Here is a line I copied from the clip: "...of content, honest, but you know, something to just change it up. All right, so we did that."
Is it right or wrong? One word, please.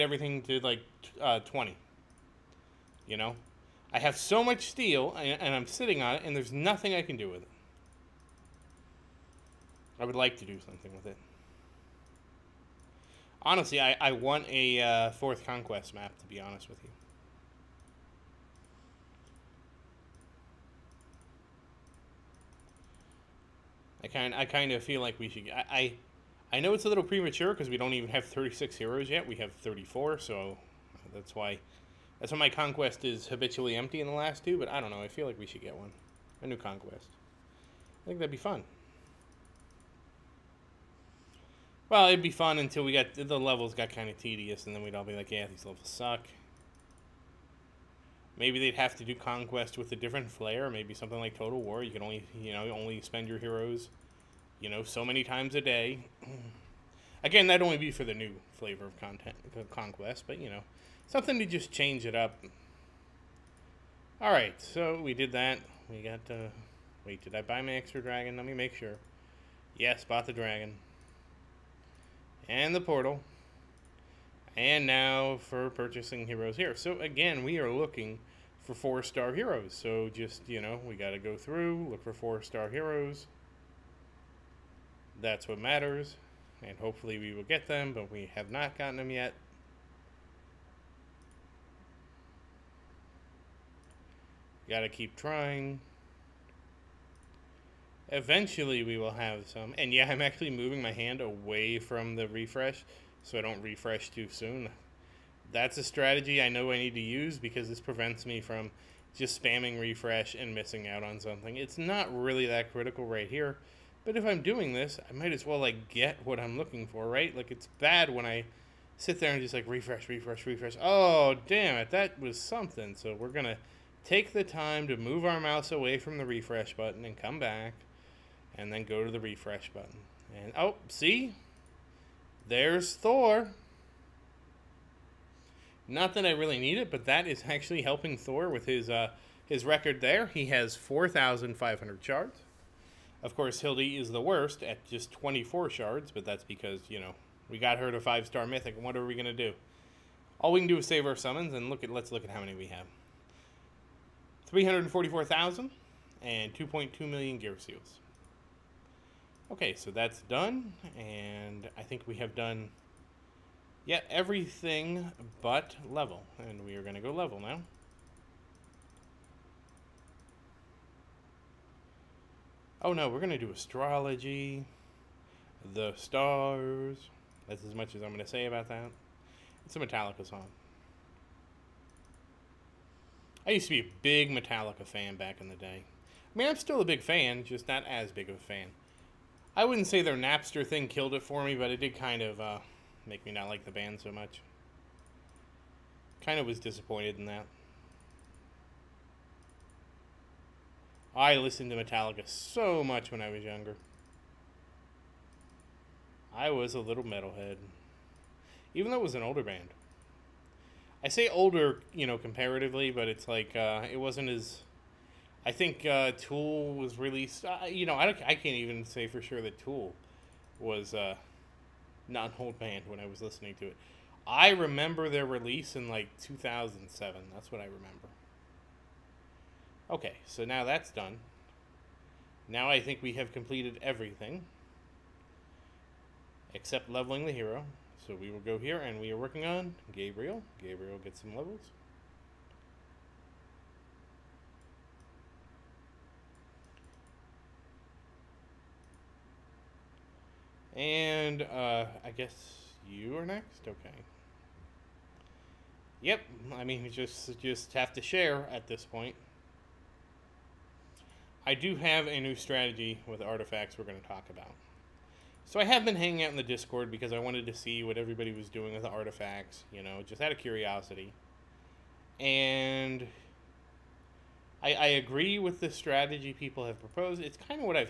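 wrong.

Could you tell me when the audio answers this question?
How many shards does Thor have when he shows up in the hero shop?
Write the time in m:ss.
2:20.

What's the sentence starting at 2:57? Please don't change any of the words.
That's as much as I'm going to say about that.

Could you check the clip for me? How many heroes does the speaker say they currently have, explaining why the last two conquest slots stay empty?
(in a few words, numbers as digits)
34.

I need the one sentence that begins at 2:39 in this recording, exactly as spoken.
Okay, so that's done, and I think we have done, yeah, everything but level, and we are going to go level now.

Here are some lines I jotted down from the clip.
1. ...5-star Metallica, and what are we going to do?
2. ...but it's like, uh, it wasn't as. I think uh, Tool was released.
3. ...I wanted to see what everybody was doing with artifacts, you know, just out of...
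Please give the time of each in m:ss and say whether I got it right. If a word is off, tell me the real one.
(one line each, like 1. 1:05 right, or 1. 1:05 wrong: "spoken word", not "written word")
1. 2:27 wrong: "Mythic", not "Metallica"
2. 3:32 right
3. 4:27 right.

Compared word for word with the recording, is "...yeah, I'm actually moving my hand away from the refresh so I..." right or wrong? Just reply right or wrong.
right.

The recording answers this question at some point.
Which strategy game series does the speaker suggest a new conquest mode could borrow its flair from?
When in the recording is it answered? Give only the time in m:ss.
0:51.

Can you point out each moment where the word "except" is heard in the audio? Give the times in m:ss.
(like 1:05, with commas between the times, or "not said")
3:56.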